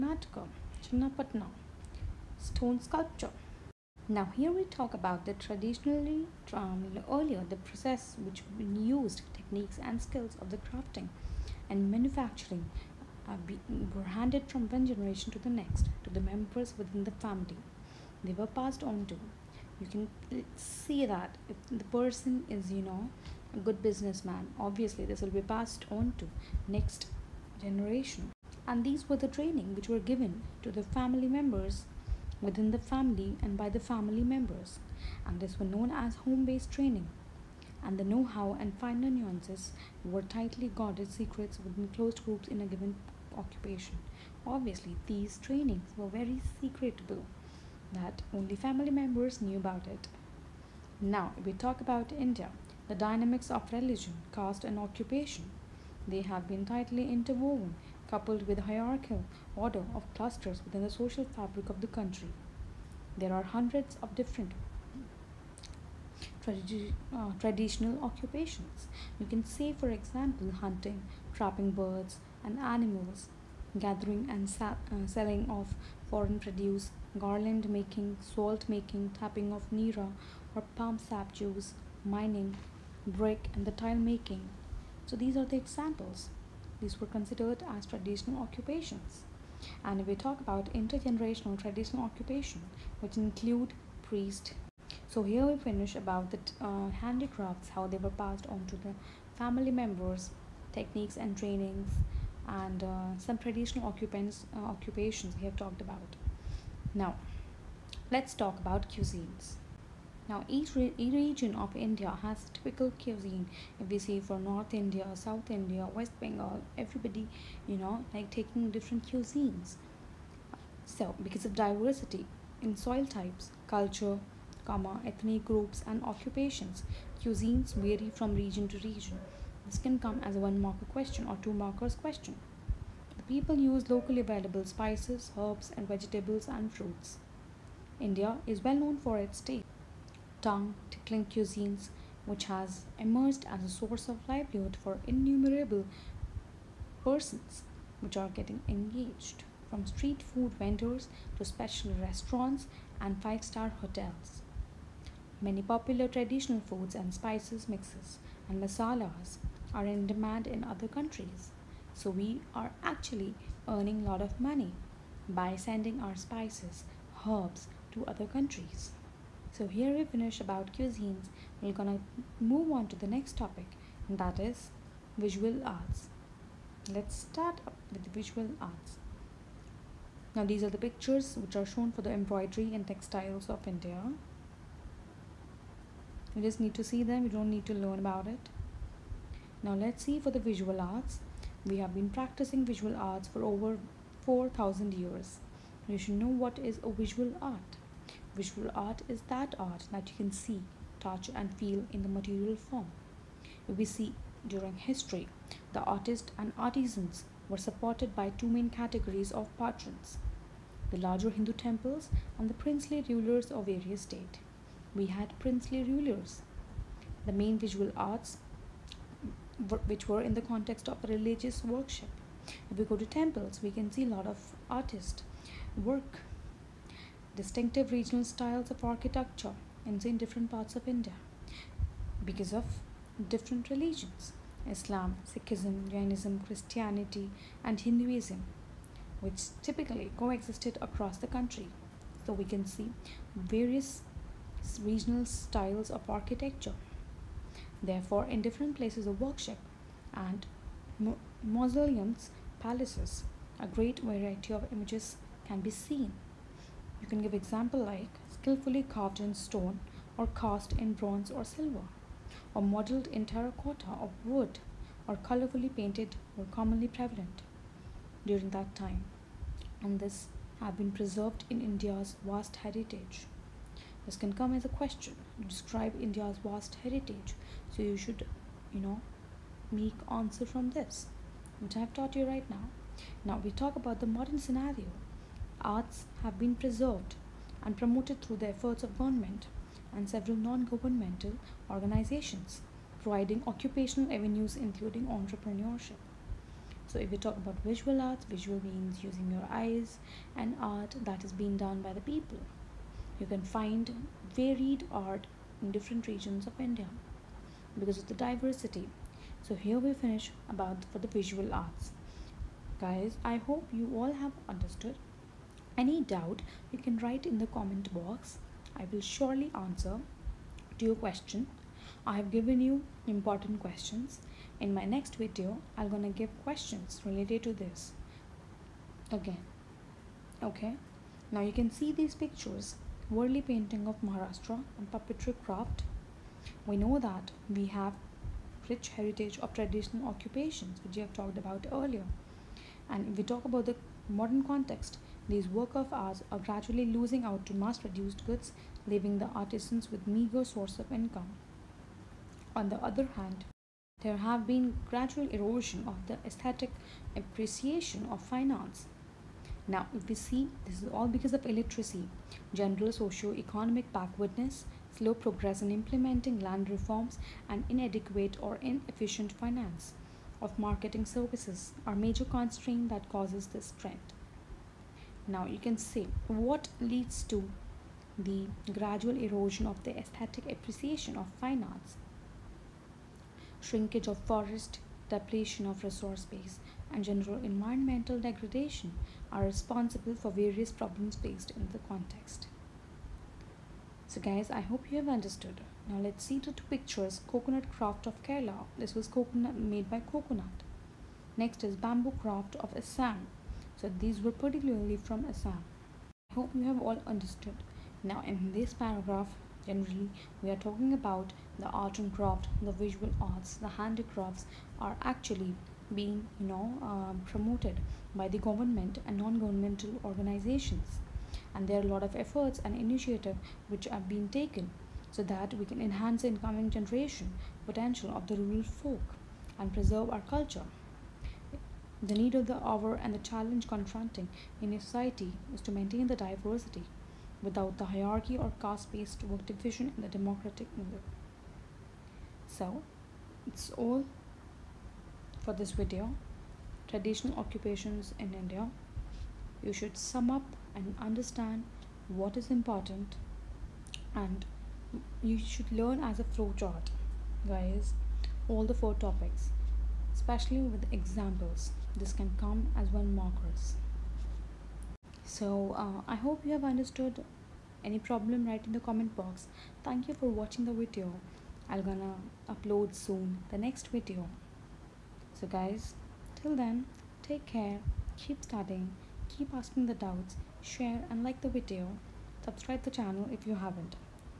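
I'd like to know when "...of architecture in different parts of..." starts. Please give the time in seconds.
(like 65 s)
228 s.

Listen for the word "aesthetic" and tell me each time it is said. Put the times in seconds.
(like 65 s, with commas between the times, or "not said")
356 s, 379 s.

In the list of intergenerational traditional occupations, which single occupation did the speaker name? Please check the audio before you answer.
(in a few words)
Priest.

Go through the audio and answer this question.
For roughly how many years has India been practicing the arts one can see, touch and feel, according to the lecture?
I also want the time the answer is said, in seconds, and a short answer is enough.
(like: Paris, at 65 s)
4000 years, at 194 s.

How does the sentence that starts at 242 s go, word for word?
So we can see various regional styles of architecture.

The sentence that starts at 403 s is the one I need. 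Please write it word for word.
So these were particularly from Assam.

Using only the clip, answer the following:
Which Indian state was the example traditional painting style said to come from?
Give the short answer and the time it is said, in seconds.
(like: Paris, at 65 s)
Maharashtra, at 334 s.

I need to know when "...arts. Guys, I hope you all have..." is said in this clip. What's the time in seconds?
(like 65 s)
311 s.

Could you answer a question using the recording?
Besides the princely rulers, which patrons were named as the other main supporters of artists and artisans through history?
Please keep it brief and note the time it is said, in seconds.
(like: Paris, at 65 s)
Larger Hindu temples, at 210 s.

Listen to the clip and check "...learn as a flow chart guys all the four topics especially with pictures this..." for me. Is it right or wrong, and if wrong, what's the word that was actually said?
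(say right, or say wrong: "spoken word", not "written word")
wrong: "examples", not "pictures".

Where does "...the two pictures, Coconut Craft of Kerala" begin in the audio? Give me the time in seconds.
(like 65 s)
396 s.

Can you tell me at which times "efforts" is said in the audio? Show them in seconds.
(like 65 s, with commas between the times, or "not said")
288 s, 422 s.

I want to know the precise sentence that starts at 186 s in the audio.
You just need to see them, you don't need to learn about it.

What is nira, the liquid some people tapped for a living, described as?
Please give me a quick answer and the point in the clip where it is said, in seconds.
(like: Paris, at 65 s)
Palm sap juice, at 80 s.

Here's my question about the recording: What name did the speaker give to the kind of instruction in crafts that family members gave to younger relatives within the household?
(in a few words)
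Home based training.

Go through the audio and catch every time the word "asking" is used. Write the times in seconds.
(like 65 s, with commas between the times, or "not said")
479 s.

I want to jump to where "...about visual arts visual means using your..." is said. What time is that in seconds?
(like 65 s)
297 s.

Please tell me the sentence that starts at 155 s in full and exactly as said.
Many popular traditional foods and spices mixes and masalas are in demand in other countries.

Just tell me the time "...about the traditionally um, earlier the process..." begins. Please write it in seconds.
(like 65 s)
4 s.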